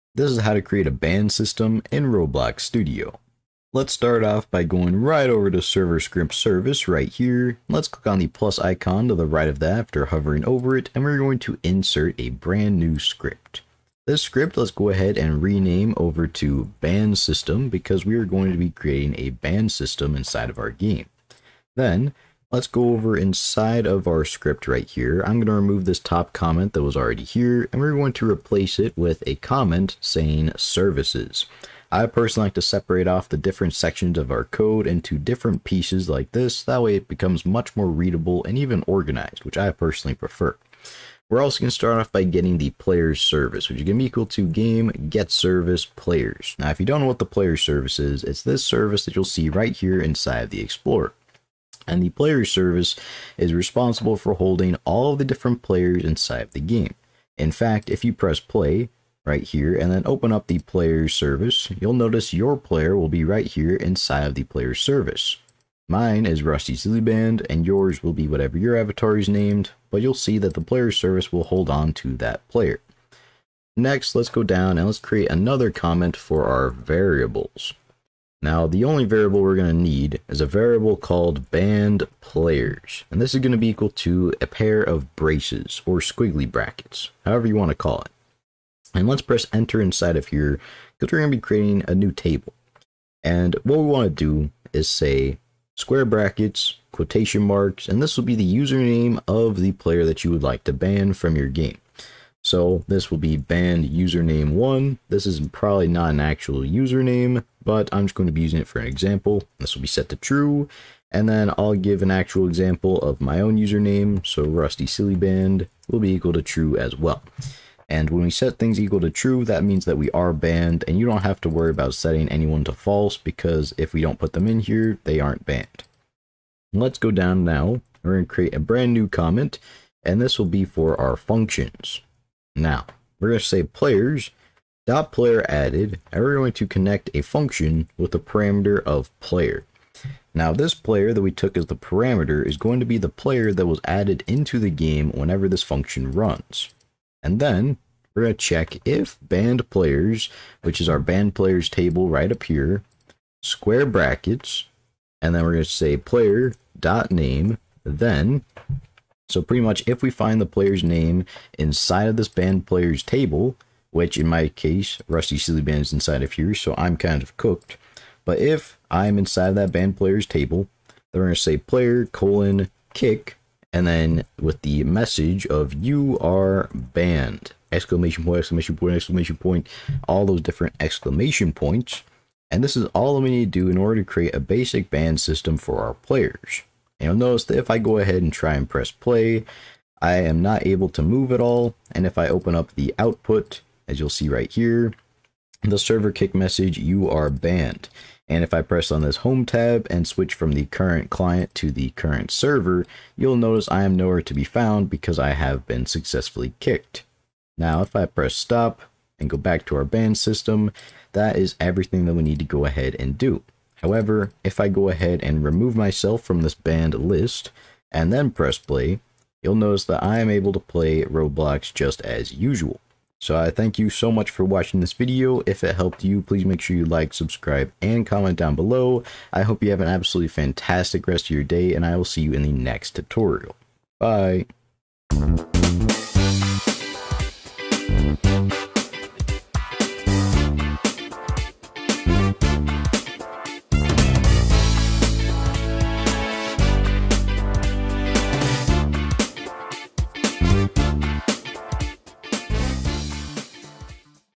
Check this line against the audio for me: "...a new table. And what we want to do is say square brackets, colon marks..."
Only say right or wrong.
wrong.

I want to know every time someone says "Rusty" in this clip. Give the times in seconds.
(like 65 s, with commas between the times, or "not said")
66 s, 114 s, 165 s.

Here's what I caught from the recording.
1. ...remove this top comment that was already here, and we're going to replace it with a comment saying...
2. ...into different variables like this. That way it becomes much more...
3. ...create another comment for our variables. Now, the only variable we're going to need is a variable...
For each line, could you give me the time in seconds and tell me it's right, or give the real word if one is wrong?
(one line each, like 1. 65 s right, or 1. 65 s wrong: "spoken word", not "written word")
1. 25 s right
2. 34 s wrong: "pieces", not "variables"
3. 74 s right.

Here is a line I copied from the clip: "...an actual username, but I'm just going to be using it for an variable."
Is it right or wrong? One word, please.
wrong.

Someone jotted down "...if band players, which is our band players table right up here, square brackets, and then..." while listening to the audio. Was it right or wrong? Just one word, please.
right.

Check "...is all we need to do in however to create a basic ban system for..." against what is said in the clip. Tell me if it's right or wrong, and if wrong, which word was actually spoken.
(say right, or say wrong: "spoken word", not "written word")
wrong: "order", not "however".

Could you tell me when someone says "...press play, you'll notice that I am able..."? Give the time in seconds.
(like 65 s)
218 s.